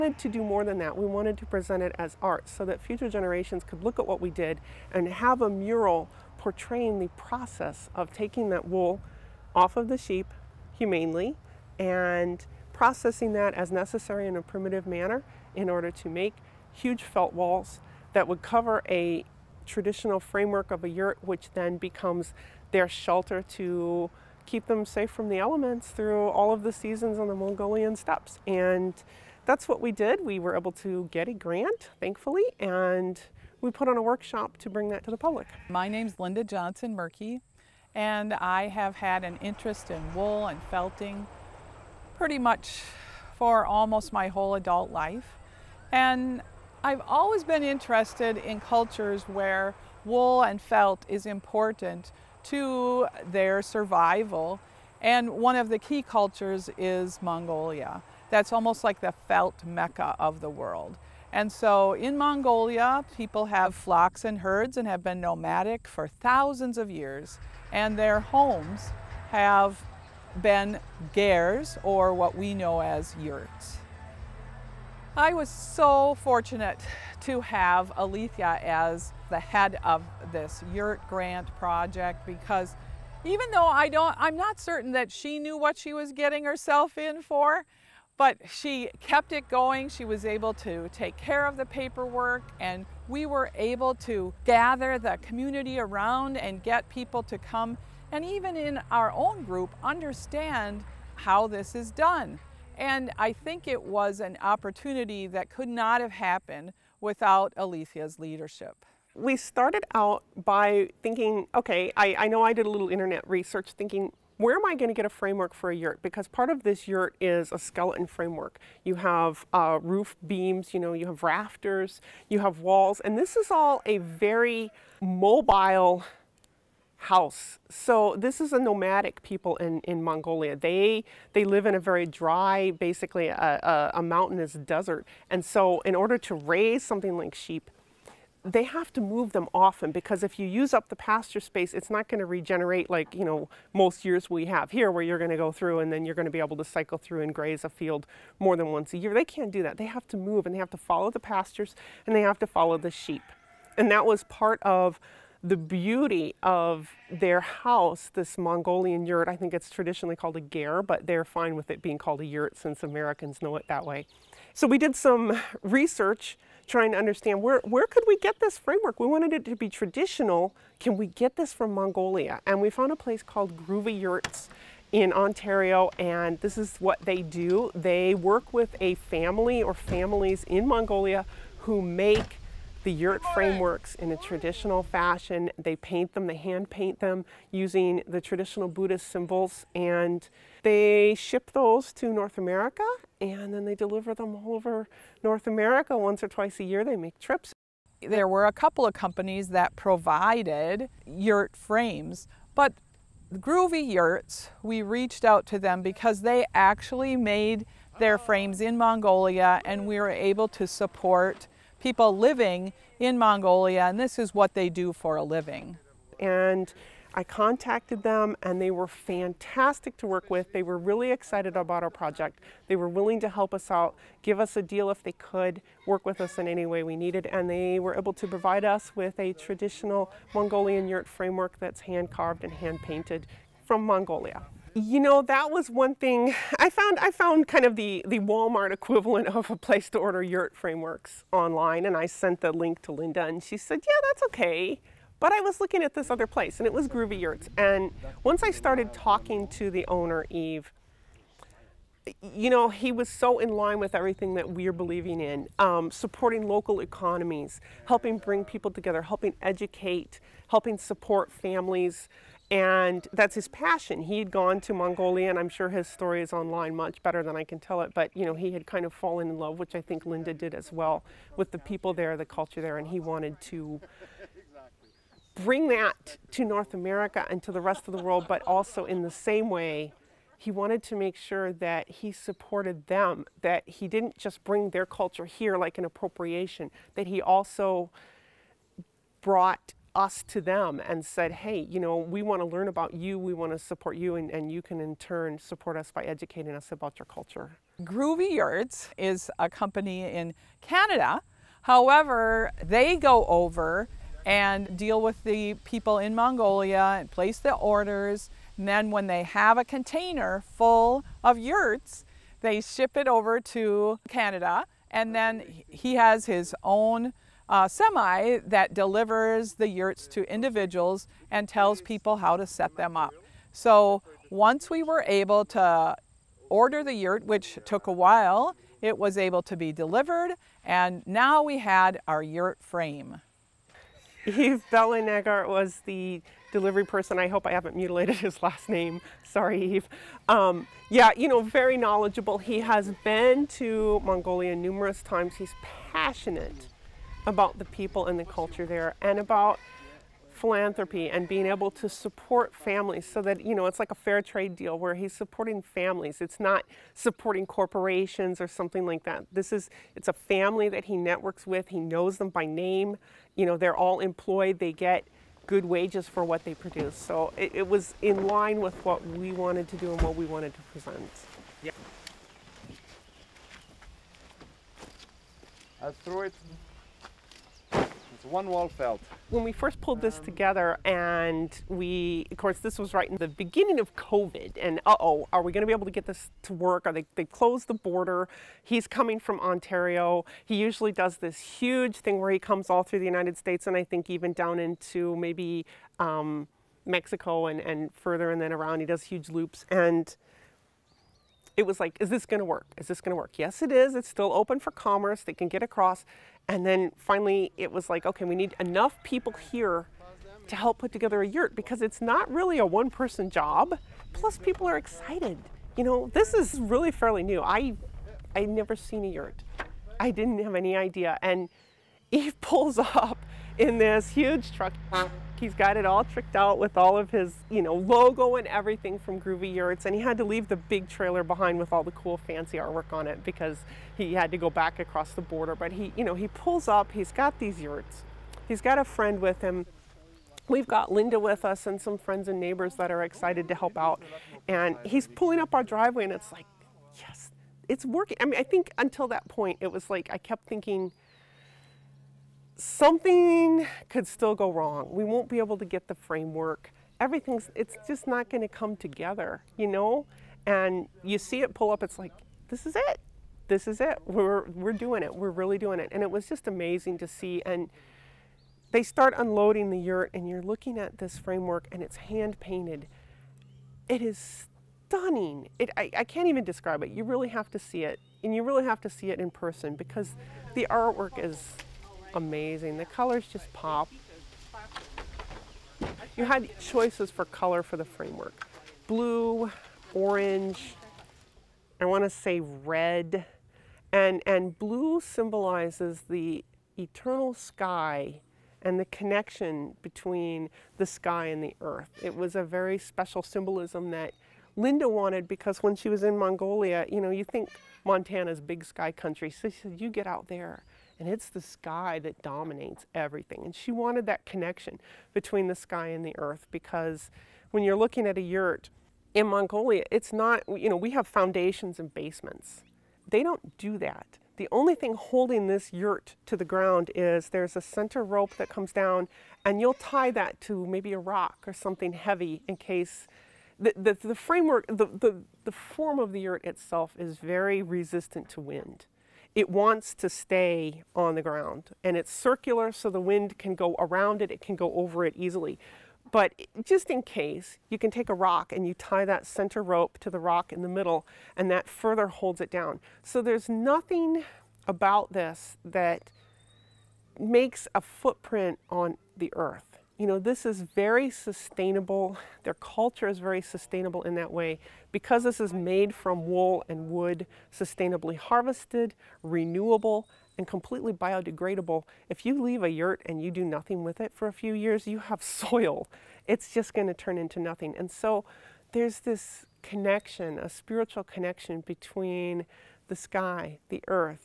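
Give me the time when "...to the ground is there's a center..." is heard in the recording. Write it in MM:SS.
08:46.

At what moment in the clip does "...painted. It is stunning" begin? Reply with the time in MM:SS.
07:52.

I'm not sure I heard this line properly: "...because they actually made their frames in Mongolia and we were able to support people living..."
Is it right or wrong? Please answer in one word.
right.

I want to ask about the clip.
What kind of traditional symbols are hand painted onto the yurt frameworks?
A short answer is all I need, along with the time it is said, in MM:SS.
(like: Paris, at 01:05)
Buddhist symbols, at 03:08.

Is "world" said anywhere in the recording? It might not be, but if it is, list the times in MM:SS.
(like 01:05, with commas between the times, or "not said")
01:00, 04:38.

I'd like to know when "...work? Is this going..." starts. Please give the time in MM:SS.
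06:42.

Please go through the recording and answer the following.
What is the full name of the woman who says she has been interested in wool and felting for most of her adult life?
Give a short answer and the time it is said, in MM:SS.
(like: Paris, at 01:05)
Linda Johnson Morke, at 00:36.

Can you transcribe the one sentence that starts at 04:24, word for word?
He had gone to Mongolia, and I'm sure his story is online much better than I can tell it.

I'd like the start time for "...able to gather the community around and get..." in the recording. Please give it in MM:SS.
01:33.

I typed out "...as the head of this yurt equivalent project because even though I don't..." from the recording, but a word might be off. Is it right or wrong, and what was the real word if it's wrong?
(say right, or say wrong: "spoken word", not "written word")
wrong: "grant", not "equivalent".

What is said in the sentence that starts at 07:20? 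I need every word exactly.
We've got Linda with us and some friends and neighbors that are excited to help out.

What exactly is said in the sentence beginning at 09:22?
Their culture is very sustainable in that way.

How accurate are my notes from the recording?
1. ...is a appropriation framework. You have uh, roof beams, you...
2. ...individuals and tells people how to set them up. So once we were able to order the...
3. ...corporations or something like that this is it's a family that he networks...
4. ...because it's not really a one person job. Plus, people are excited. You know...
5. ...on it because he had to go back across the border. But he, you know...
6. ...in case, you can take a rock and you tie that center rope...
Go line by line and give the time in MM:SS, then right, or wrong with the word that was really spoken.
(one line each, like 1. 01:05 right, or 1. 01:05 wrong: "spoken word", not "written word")
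1. 01:57 wrong: "skeleton", not "appropriation"
2. 05:20 right
3. 05:57 right
4. 06:51 right
5. 07:12 right
6. 09:06 right.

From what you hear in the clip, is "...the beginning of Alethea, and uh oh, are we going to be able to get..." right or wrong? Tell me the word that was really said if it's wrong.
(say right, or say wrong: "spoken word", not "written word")
wrong: "COVID", not "Alethea".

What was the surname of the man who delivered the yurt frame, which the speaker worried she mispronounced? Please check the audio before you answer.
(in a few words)
Bellinegart.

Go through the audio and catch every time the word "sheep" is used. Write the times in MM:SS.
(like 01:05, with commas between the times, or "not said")
00:09, 02:17, 02:32.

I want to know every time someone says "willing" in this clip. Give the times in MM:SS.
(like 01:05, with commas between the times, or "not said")
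03:42.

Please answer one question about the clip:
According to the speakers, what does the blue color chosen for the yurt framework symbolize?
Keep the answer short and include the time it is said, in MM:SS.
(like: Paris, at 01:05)
The eternal sky, at 08:16.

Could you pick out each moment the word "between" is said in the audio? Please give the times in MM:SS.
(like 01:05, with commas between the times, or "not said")
08:19, 08:35, 09:41.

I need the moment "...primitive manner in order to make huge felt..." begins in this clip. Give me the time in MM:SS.
00:14.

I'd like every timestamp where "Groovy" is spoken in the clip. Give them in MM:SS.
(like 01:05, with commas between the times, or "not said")
02:53, 03:23, 04:06, 04:57, 07:09.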